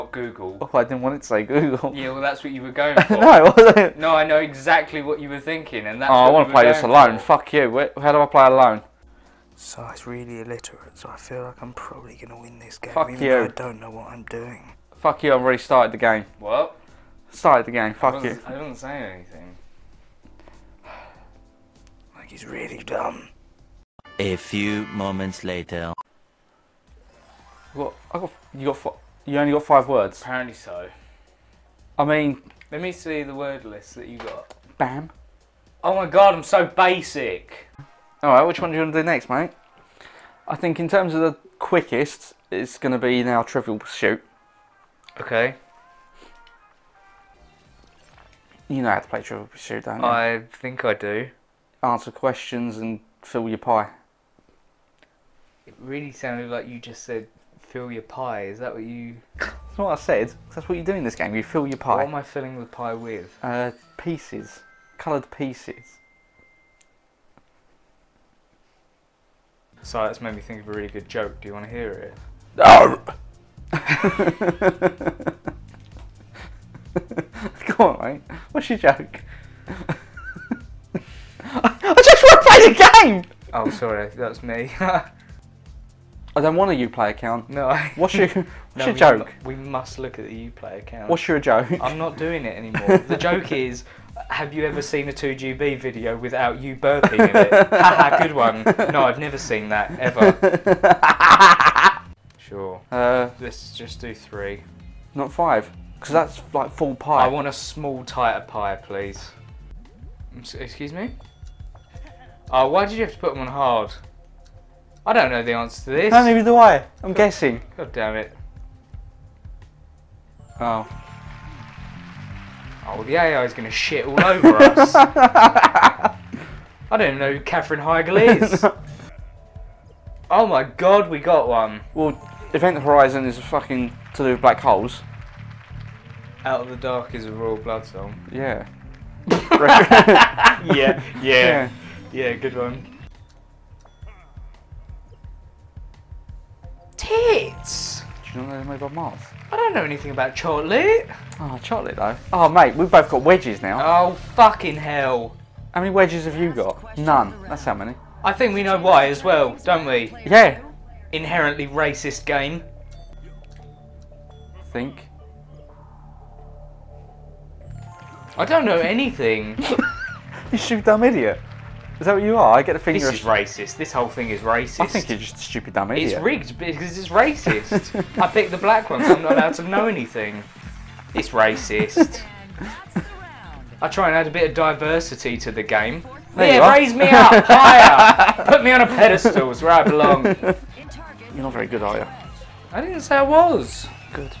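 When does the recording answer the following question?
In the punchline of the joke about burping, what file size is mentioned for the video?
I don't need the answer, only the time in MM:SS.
01:35.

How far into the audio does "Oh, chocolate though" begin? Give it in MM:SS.
02:31.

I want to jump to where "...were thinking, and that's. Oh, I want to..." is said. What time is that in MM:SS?
00:05.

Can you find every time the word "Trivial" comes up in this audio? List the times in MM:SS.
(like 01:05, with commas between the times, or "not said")
00:43, 00:49.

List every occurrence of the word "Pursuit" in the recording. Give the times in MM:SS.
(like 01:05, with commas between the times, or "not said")
00:43, 00:49.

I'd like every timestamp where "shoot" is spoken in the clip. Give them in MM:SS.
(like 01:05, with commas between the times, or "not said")
02:50.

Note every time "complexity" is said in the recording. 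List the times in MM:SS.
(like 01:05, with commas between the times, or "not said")
not said.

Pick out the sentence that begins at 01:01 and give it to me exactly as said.
What am I filling the pie with?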